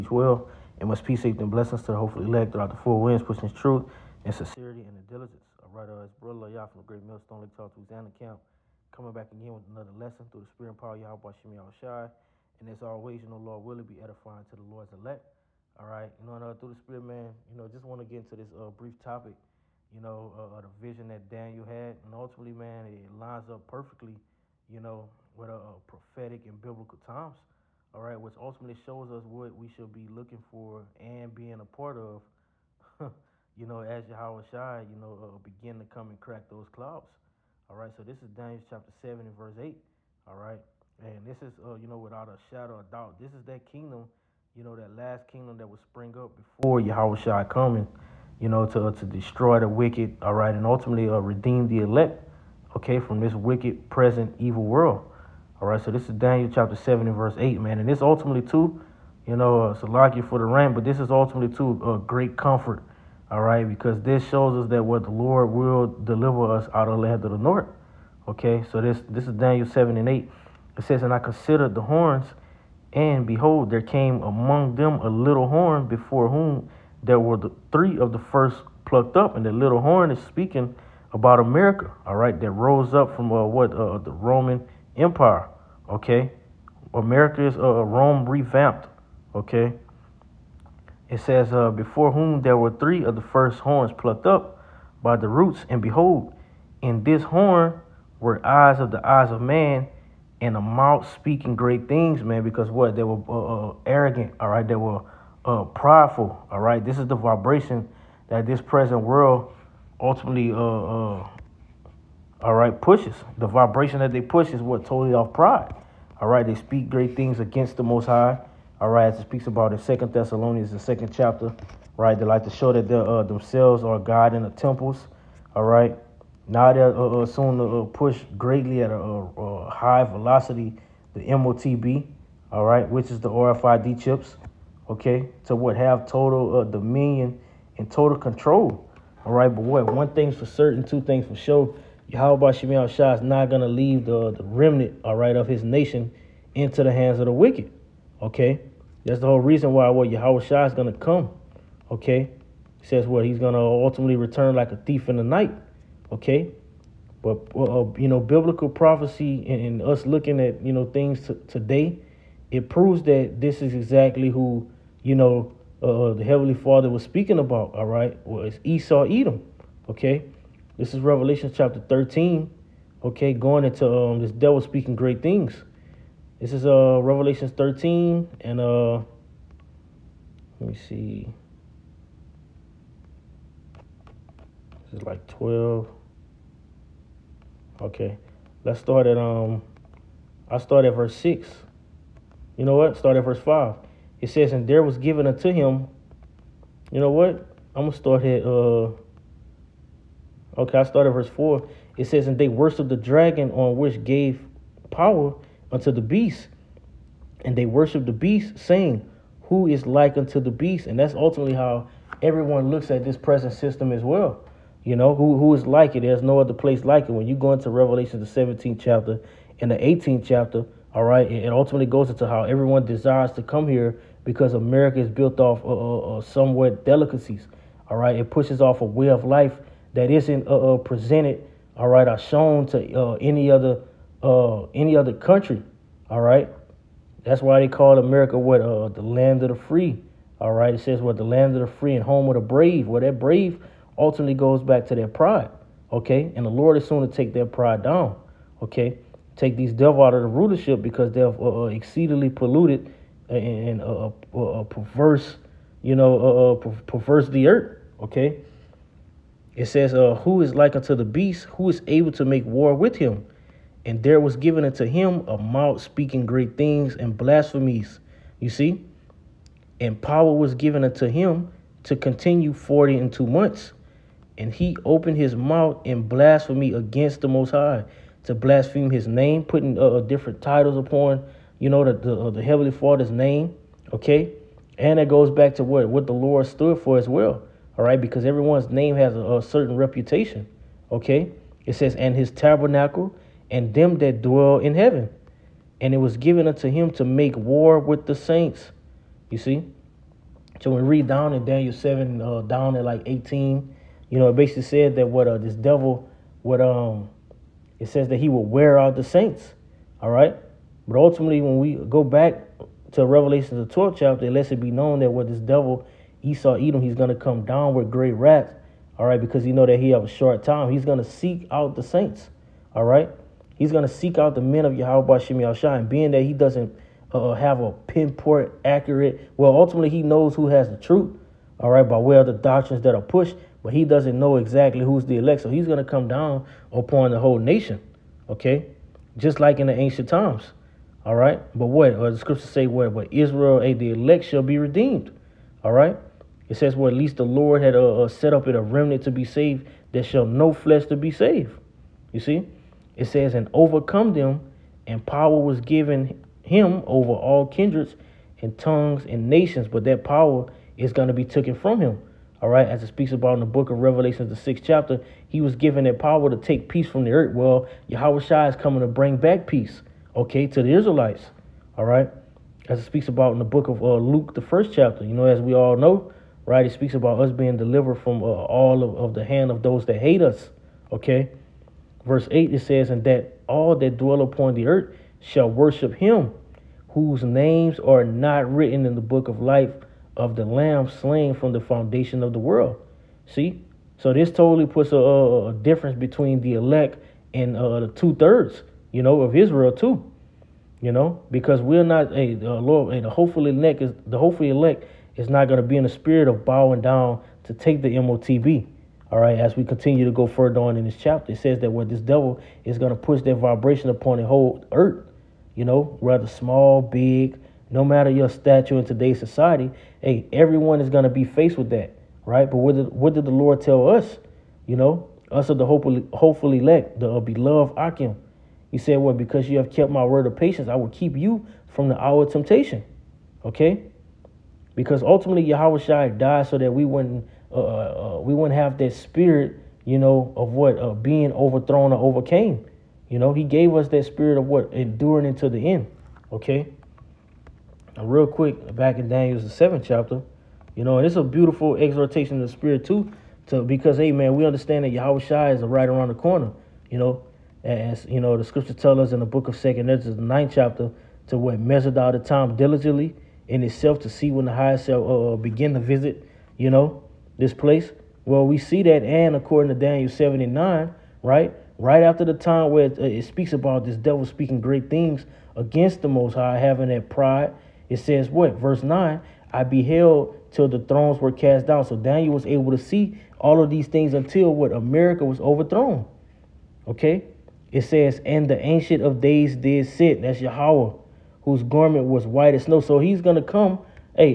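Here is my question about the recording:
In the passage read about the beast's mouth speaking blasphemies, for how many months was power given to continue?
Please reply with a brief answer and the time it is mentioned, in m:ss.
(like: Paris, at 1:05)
42, at 4:32.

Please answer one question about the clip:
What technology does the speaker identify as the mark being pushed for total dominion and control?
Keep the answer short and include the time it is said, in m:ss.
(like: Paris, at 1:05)
RFID chips, at 2:13.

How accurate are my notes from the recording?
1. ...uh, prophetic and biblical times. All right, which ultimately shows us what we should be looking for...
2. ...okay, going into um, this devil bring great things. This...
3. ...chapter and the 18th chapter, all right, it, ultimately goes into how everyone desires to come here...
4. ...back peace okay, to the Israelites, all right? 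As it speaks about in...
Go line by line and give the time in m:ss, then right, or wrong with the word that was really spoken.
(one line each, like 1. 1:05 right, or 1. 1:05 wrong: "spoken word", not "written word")
1. 0:25 right
2. 2:53 wrong: "speaking", not "bring"
3. 3:38 right
4. 6:09 right.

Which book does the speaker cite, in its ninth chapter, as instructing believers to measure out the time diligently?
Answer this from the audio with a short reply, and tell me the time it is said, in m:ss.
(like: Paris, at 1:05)
Second Ezra, at 7:39.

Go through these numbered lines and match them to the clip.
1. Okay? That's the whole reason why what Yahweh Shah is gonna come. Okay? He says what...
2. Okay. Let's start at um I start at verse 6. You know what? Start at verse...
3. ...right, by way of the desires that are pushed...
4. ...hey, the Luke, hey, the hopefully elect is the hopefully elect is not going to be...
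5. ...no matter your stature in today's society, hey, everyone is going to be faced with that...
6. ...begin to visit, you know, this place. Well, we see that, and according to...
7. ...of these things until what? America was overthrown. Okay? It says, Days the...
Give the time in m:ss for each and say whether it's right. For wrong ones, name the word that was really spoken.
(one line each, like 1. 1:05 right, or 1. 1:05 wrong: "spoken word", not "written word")
1. 2:28 right
2. 3:07 right
3. 5:31 wrong: "doctrines", not "desires"
4. 6:42 wrong: "Lord", not "Luke"
5. 6:57 right
6. 7:45 right
7. 8:03 wrong: "And", not "Days".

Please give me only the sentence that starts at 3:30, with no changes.
And that's ultimately how everyone looks at this present system as well.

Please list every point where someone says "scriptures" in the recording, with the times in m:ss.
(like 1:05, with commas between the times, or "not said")
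5:42, 7:38.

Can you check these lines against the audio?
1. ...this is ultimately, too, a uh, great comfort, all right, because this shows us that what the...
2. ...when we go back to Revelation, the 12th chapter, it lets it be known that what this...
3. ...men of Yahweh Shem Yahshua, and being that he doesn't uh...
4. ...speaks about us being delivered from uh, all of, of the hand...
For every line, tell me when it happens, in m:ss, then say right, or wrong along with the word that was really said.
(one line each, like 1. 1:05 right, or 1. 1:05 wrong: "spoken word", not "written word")
1. 1:00 right
2. 5:11 right
3. 5:24 right
4. 6:16 right.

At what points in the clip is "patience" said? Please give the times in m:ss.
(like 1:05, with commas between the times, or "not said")
7:10.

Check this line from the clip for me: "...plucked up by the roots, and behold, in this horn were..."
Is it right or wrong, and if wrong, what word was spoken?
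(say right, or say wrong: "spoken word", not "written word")
right.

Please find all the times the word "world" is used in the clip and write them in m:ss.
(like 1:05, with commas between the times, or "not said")
0:54, 1:49, 6:32.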